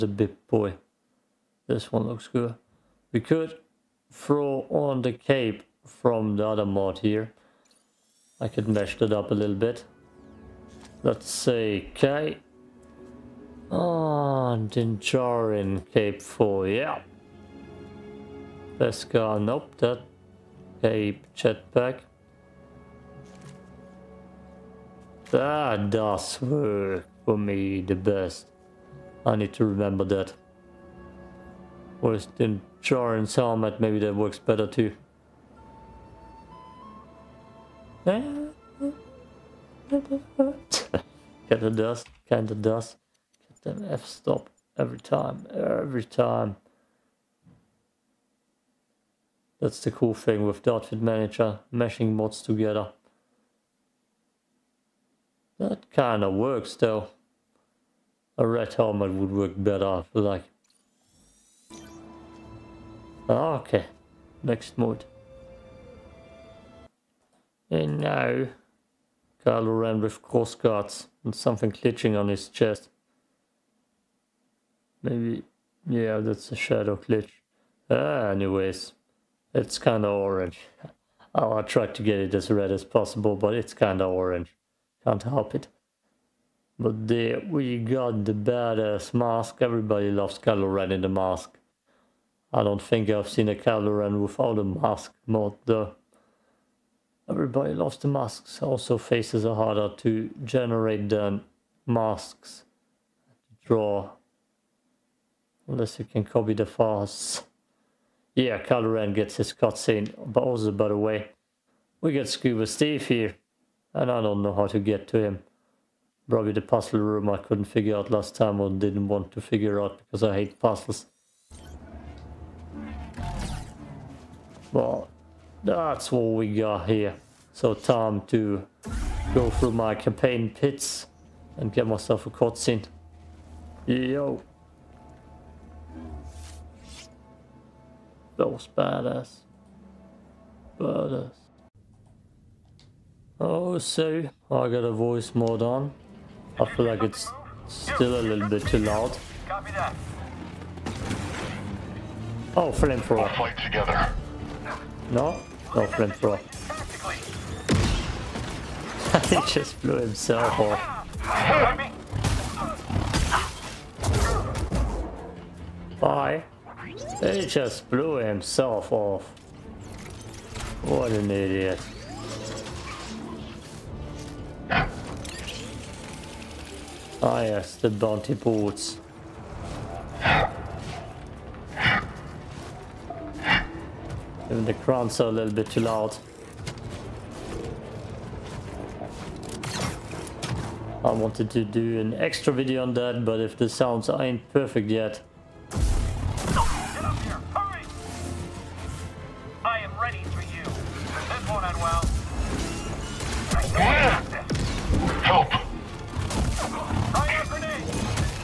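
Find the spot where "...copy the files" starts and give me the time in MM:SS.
01:46.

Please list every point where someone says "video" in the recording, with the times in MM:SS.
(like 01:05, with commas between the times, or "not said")
03:12.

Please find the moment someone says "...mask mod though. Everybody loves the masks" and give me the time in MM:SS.
01:34.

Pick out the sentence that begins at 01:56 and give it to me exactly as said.
Probably the puzzle room I couldn't figure out last time or didn't want to figure out because I hate puzzles.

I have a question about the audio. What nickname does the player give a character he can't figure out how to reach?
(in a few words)
Scuba Steve.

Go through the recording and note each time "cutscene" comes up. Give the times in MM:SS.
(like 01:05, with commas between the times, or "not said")
01:49, 02:12.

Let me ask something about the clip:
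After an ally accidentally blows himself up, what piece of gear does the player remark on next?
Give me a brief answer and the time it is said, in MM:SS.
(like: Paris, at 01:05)
bounty boots, at 02:57.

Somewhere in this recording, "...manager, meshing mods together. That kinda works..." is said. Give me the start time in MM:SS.
00:50.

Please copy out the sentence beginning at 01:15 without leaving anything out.
Maybe, yeah, that's a shadow glitch.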